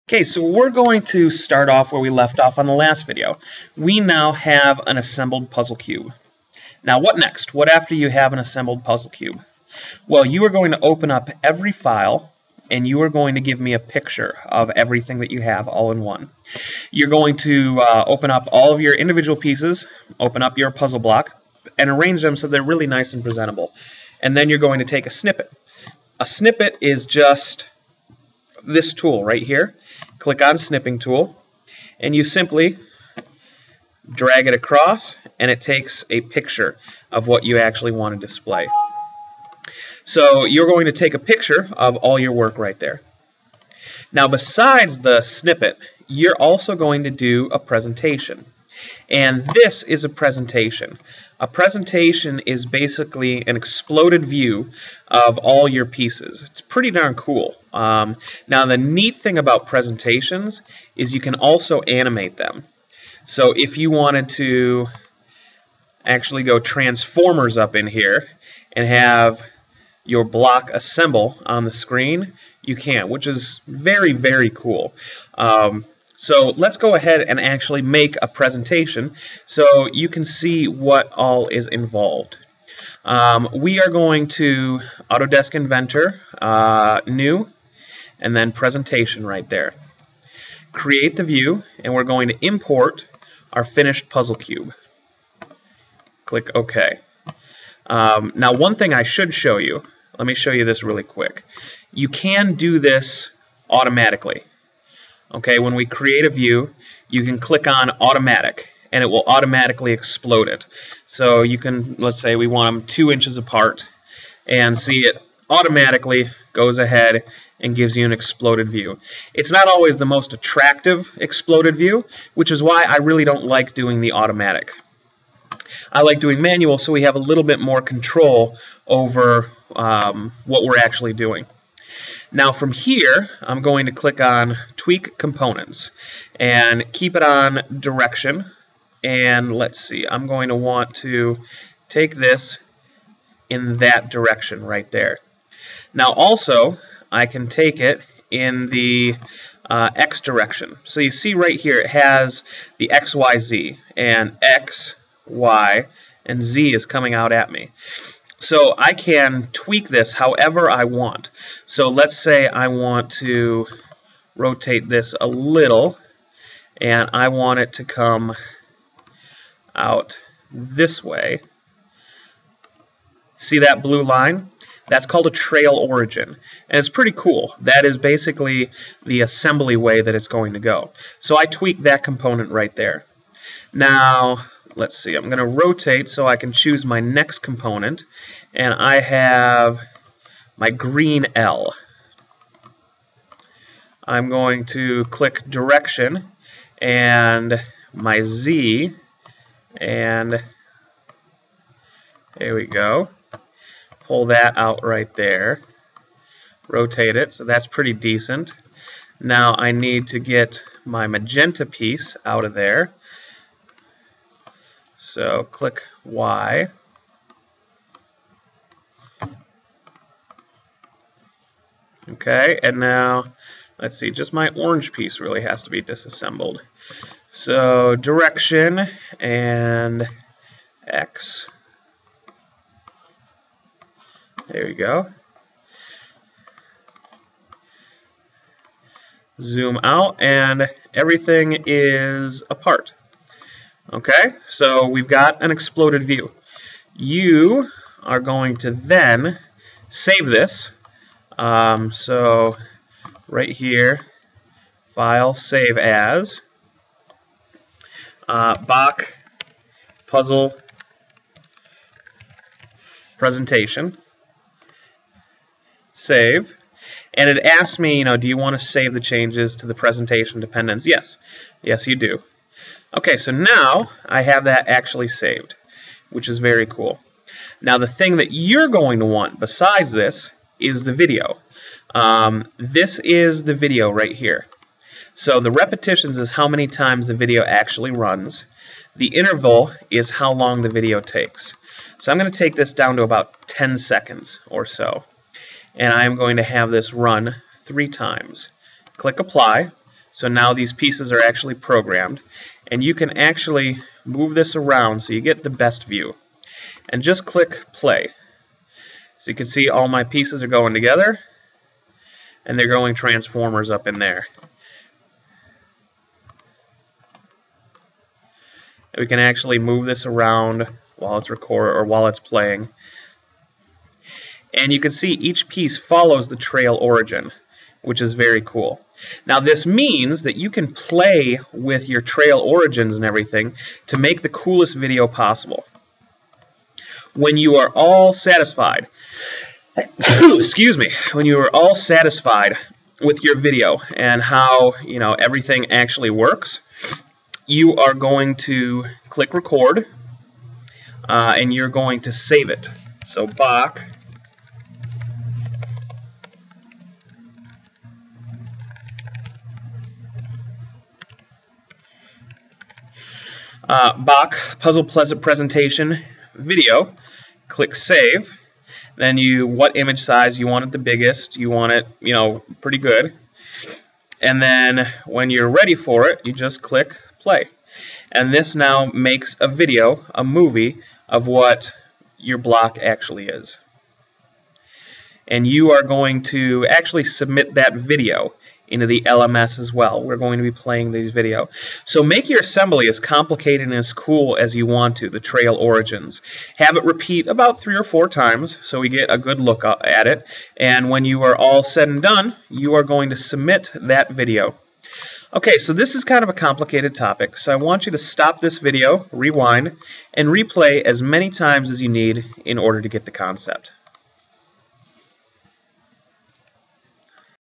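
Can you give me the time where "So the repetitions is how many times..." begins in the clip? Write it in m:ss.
4:45.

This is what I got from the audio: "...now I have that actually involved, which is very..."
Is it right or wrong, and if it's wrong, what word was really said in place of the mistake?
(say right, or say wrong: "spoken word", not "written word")
wrong: "saved", not "involved".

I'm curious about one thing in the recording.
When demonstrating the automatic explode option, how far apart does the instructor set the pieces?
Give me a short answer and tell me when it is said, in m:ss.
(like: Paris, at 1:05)
2 inches, at 1:52.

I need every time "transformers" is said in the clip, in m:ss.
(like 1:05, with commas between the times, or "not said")
1:06, 5:12.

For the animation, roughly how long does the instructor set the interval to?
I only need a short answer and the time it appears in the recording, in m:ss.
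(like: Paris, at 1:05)
10 seconds, at 4:53.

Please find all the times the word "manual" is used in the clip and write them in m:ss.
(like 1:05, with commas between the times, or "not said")
2:06.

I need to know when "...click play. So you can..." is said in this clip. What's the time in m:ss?
5:07.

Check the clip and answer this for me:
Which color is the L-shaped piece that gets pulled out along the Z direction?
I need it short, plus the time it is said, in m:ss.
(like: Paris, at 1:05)
Green, at 3:10.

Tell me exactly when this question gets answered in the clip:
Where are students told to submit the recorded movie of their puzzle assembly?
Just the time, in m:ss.
6:29.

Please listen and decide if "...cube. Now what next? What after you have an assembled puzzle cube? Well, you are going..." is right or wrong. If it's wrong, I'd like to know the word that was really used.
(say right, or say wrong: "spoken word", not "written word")
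right.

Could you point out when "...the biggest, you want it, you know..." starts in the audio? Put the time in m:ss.
6:10.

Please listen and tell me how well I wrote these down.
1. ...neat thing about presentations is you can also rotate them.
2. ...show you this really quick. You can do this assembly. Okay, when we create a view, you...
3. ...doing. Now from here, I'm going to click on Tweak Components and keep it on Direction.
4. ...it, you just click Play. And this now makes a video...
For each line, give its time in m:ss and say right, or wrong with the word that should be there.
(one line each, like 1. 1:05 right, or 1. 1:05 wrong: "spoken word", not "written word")
1. 0:58 wrong: "animate", not "rotate"
2. 1:40 wrong: "automatically", not "assembly"
3. 2:11 right
4. 6:16 right.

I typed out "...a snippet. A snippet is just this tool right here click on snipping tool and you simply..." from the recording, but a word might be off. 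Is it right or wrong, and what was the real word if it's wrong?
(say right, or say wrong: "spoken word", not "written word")
right.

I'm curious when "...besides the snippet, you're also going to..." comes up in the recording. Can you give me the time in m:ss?
0:44.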